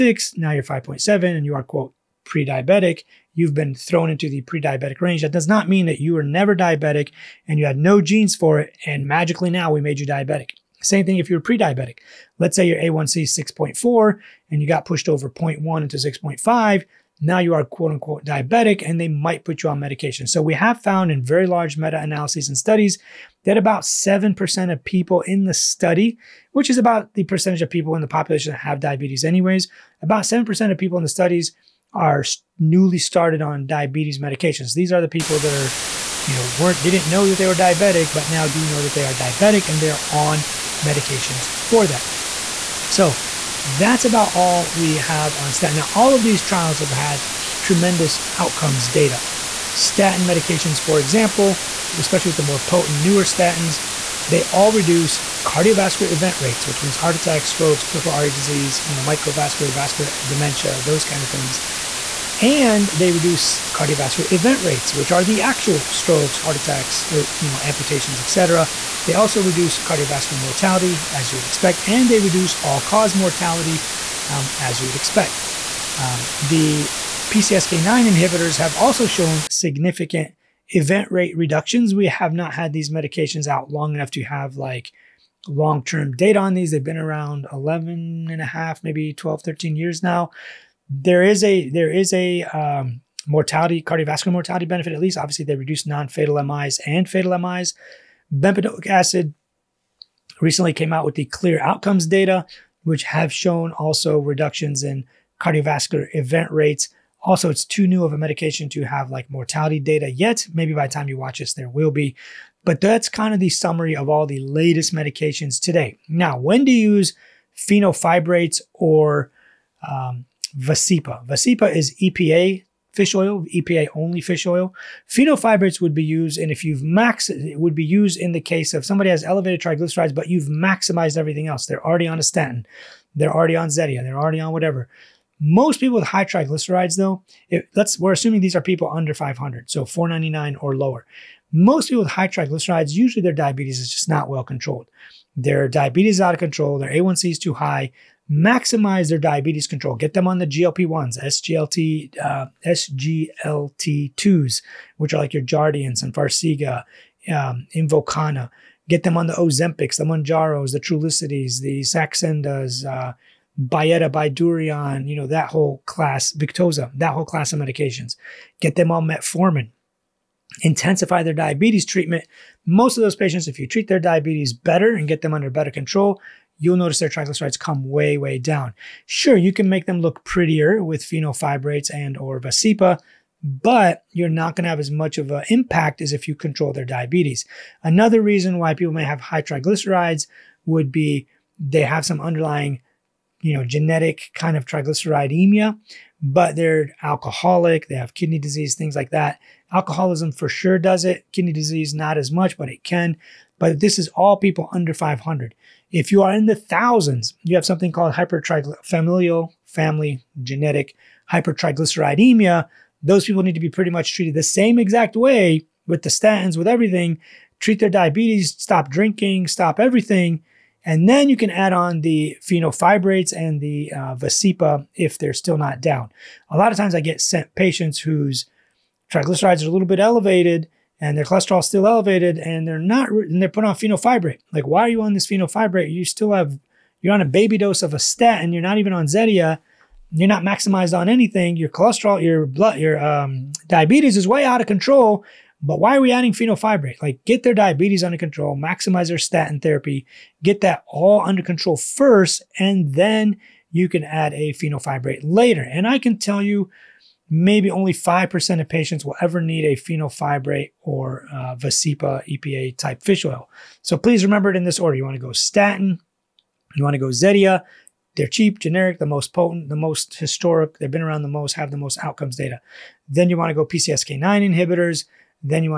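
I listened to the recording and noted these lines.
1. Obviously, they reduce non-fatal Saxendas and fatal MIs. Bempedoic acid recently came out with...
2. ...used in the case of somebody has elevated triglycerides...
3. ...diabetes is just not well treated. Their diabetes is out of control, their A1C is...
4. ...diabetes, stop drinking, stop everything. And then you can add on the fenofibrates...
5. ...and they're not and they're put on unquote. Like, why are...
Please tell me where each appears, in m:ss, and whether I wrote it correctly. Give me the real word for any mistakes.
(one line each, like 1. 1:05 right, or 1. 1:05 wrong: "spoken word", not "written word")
1. 1:35 wrong: "MIs", not "Saxendas"
2. 2:07 right
3. 2:23 wrong: "controlled", not "treated"
4. 3:37 right
5. 3:52 wrong: "fenofibrate", not "unquote".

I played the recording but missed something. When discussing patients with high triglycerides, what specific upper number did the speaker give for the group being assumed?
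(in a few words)
499.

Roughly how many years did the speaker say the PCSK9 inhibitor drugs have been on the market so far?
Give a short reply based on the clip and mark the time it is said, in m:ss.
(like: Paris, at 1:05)
11 and a half years, at 1:27.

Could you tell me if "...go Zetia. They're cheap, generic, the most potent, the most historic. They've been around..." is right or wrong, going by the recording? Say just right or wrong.
right.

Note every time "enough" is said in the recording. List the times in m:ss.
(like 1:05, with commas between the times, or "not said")
1:23.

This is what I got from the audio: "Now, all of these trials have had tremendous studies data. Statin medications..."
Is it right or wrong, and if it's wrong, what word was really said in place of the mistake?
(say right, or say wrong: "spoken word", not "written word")
wrong: "outcomes", not "studies".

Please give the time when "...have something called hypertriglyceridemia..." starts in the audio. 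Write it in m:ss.
3:27.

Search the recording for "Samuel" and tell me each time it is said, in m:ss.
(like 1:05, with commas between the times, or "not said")
not said.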